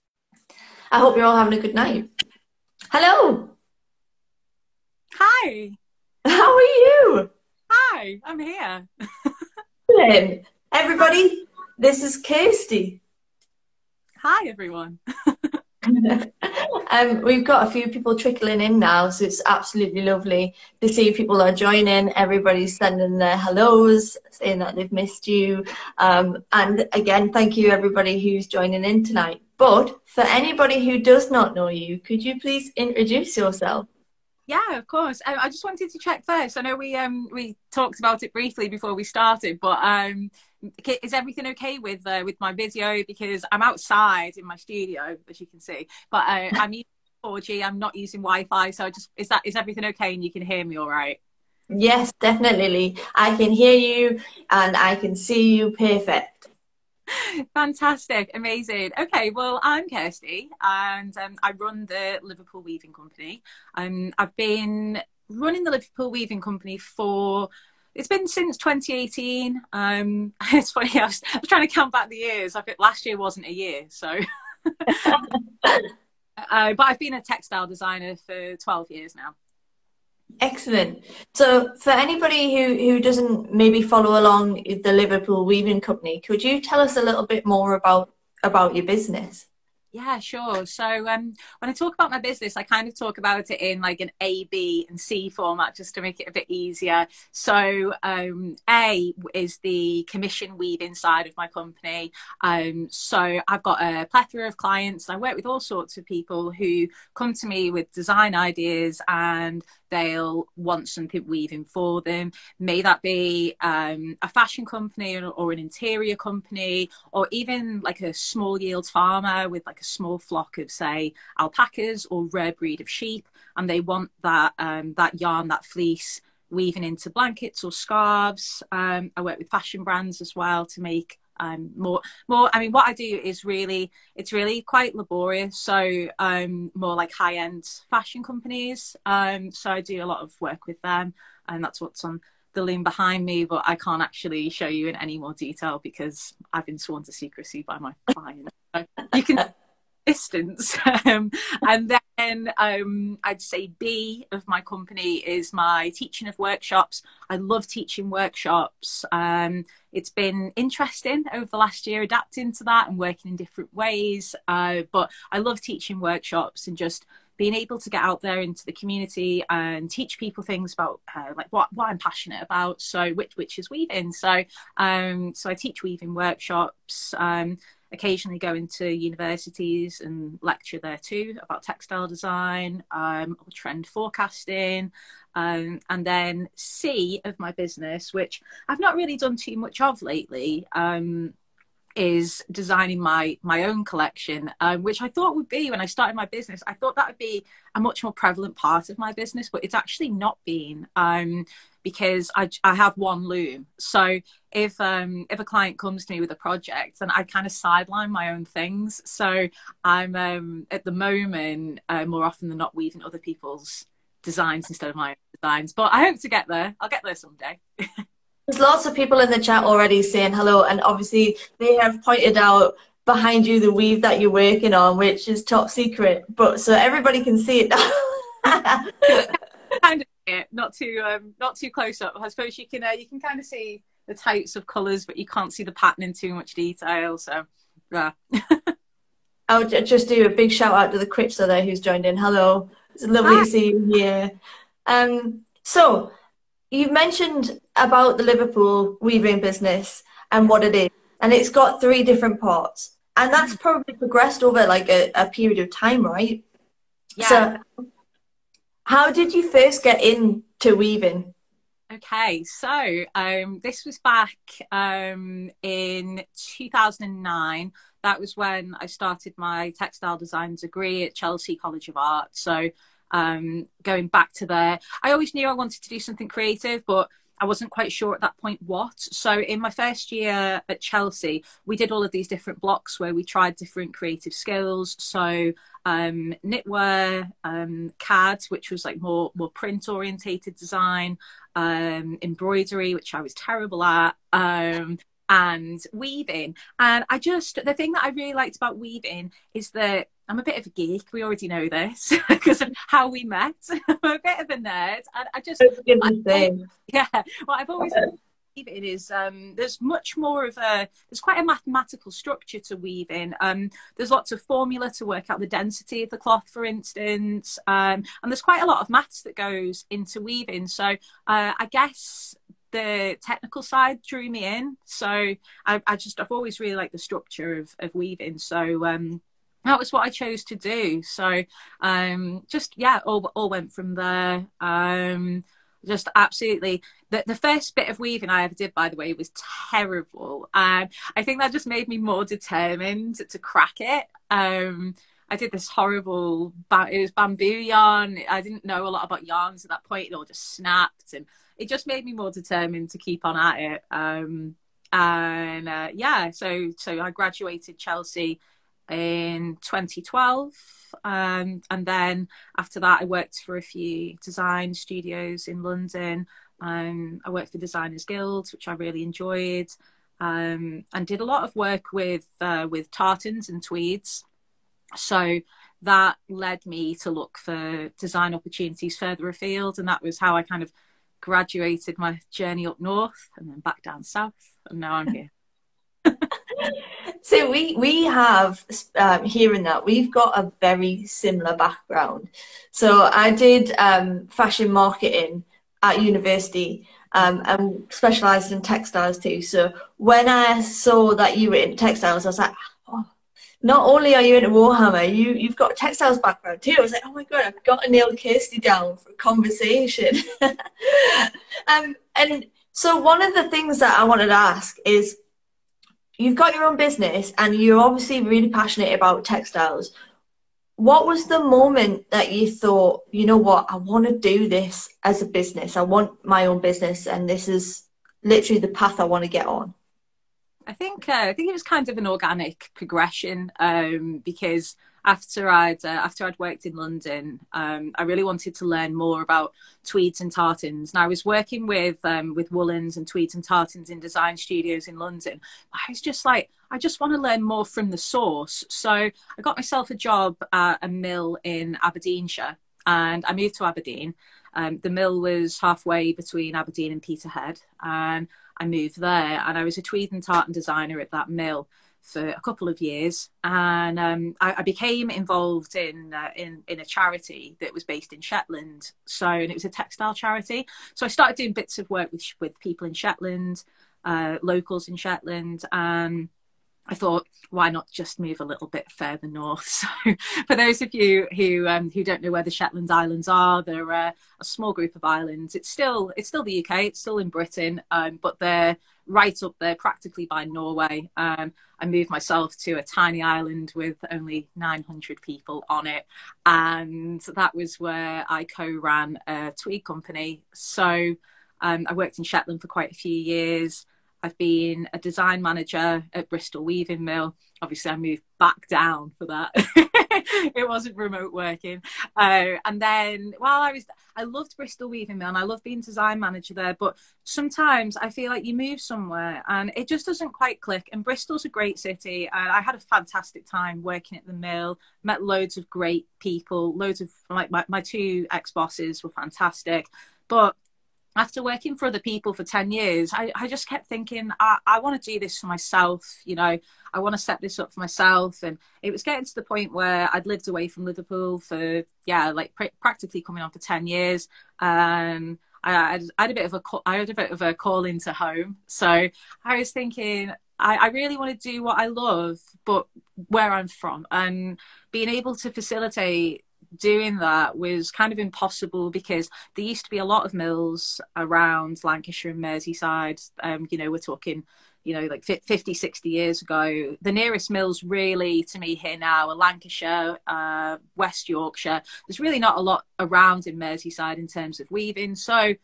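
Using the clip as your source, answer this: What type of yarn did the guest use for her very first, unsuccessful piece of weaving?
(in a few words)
Bamboo.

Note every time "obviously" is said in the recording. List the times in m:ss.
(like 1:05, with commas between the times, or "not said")
3:40, 6:57, 8:27.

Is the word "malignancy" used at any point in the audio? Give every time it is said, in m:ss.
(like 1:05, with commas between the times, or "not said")
not said.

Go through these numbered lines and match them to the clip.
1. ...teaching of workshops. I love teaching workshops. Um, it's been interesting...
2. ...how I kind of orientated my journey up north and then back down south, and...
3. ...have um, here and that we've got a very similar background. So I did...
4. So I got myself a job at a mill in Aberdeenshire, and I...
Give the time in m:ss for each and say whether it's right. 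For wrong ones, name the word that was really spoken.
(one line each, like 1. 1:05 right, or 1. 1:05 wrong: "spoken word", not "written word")
1. 2:35 right
2. 6:20 wrong: "graduated", not "orientated"
3. 6:28 right
4. 7:28 right.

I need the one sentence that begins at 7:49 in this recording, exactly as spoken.
So, and it was a textile charity.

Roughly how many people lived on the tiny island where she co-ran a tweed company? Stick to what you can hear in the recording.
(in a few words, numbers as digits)
900.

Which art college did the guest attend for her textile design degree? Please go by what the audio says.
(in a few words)
Chelsea College of Art.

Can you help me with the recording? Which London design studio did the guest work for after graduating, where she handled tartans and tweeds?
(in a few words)
Designers Guild.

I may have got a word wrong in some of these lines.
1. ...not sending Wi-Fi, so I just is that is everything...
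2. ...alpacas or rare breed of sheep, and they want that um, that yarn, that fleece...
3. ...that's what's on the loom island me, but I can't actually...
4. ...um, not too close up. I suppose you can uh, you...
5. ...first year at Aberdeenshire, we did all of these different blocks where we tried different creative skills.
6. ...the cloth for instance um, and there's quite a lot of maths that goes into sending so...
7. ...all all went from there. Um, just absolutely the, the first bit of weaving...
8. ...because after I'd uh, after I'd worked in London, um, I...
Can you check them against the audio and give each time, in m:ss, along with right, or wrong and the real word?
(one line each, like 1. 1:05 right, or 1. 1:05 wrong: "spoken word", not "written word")
1. 0:47 wrong: "using", not "sending"
2. 2:01 right
3. 2:21 wrong: "behind", not "island"
4. 3:51 right
5. 4:39 wrong: "Chelsea", not "Aberdeenshire"
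6. 5:16 wrong: "weaving", not "sending"
7. 5:33 right
8. 7:14 right.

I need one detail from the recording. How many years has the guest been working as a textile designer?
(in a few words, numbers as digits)
12.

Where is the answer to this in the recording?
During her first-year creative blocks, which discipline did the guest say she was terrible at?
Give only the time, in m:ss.
4:52.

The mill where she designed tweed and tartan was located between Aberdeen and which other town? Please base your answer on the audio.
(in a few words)
Peterhead.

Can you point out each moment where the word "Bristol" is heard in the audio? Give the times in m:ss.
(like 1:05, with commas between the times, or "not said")
8:26, 8:34, 8:41.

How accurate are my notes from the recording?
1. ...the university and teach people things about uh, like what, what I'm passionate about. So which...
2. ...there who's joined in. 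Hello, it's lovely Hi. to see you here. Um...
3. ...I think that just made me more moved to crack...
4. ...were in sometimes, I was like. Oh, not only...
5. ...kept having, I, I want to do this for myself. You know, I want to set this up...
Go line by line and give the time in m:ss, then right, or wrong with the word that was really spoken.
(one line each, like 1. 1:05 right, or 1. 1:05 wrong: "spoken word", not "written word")
1. 2:48 wrong: "community", not "university"
2. 4:01 right
3. 5:41 wrong: "determined", not "moved"
4. 6:41 wrong: "textiles", not "sometimes"
5. 8:53 wrong: "thinking", not "having".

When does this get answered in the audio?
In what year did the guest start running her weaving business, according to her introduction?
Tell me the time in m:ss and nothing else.
1:08.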